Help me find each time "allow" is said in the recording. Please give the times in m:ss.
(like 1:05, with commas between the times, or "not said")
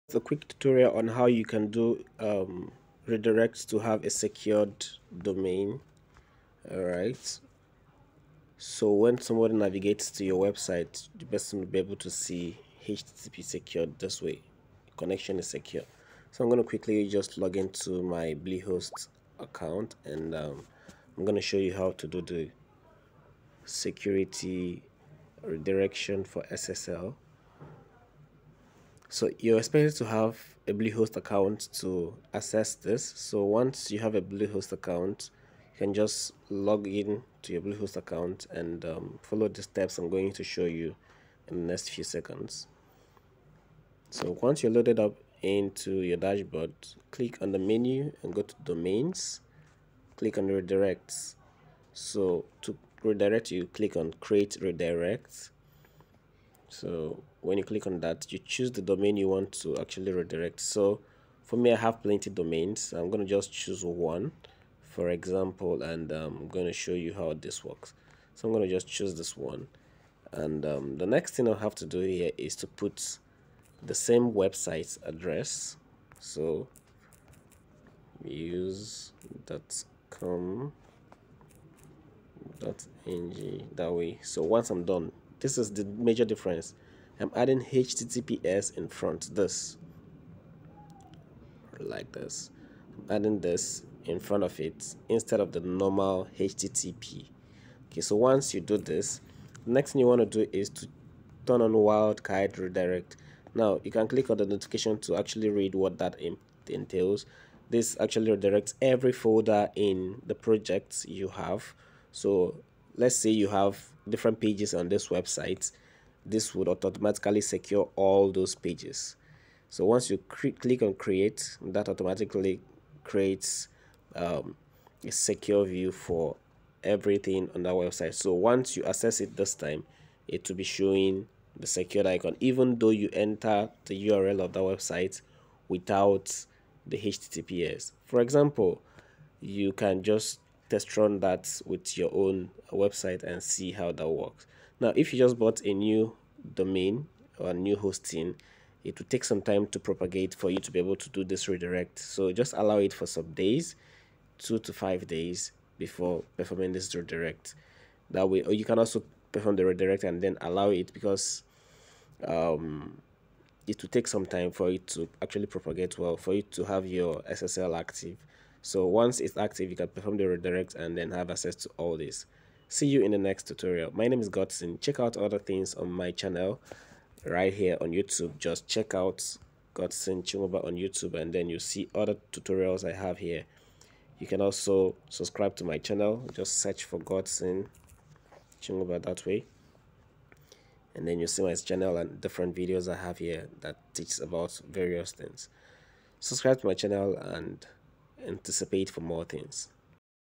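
2:32, 2:40.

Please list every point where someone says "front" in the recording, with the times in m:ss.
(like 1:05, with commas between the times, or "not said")
1:28, 1:34.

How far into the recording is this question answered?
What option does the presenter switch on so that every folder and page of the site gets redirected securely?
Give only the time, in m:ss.
1:41.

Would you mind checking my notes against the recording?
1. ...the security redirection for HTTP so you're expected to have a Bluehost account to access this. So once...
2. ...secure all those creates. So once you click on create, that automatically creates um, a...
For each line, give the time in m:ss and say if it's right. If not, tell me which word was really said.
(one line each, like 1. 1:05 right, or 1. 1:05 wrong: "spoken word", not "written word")
1. 0:22 wrong: "SSL", not "HTTP"
2. 1:57 wrong: "pages", not "creates".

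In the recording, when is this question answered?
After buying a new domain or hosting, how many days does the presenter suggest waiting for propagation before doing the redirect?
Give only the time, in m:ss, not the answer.
2:34.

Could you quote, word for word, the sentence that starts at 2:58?
Just check out Godson Chinweuba on YouTube and then you see other tutorials I have here.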